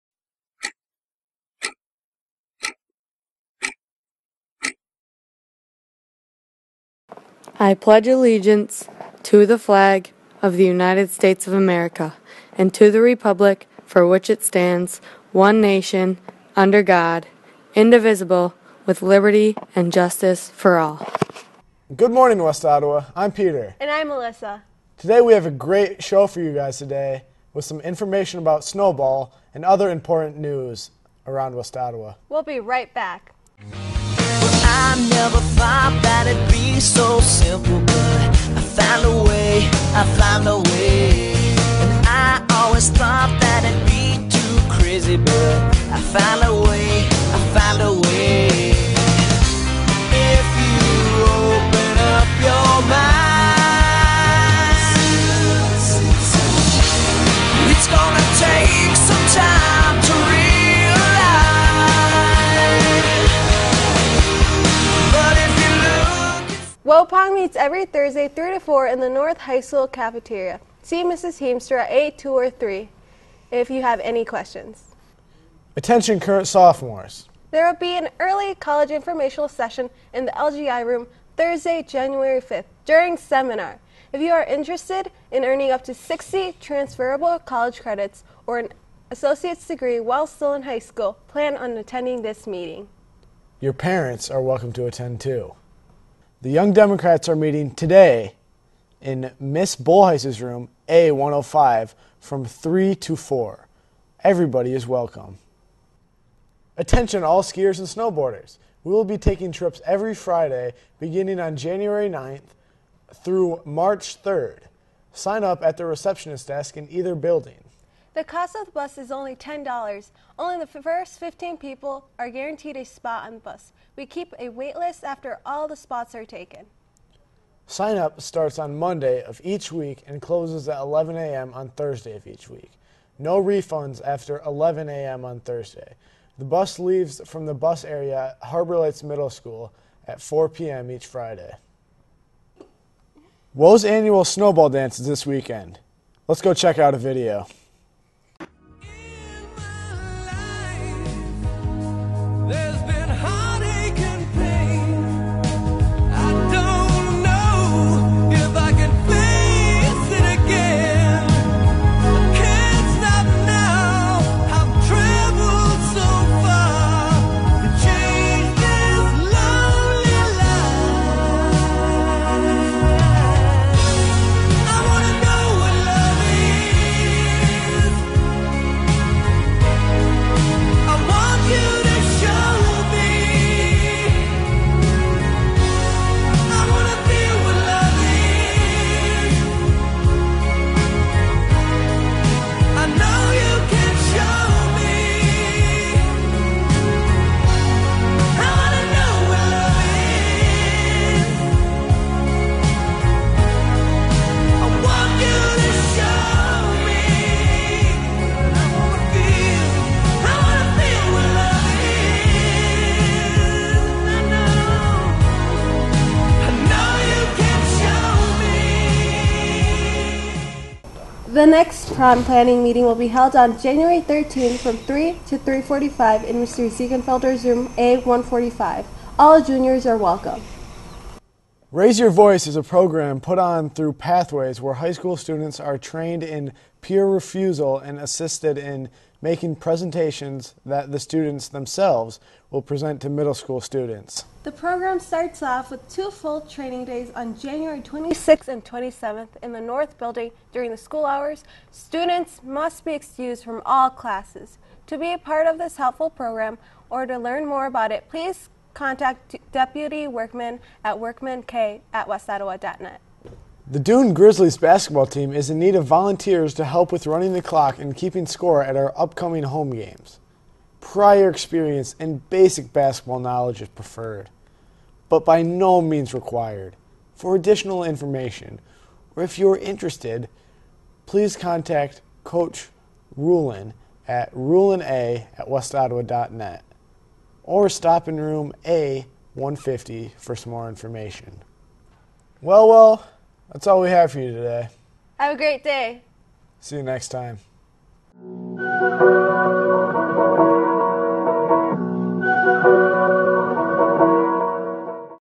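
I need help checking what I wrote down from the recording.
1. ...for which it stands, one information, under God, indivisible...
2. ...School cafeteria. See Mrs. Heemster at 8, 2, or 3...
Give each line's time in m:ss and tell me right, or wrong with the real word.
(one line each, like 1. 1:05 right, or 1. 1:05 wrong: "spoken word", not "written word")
1. 0:13 wrong: "nation", not "information"
2. 1:09 right.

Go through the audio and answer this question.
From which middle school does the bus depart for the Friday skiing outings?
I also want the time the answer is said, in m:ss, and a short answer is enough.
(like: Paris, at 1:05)
Harbor Lights Middle School, at 2:18.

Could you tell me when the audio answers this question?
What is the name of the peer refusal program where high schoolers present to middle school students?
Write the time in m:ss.
3:51.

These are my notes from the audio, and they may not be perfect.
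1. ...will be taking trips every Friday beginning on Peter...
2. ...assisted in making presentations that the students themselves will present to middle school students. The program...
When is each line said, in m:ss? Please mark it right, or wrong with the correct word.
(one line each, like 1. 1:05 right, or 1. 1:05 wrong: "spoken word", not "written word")
1. 1:48 wrong: "January", not "Peter"
2. 3:57 right.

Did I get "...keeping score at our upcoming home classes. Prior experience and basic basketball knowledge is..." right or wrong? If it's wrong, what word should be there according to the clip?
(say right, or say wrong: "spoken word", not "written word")
wrong: "games", not "classes".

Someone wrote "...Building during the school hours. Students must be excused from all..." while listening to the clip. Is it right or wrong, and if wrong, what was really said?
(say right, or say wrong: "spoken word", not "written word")
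right.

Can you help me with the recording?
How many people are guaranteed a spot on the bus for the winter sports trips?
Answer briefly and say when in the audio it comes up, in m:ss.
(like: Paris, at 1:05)
15, at 2:01.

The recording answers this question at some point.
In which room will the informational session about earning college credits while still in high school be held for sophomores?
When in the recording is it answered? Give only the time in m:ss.
1:20.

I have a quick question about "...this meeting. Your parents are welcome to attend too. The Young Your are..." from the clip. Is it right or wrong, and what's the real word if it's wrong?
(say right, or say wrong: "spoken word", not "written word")
wrong: "Democrats", not "Your".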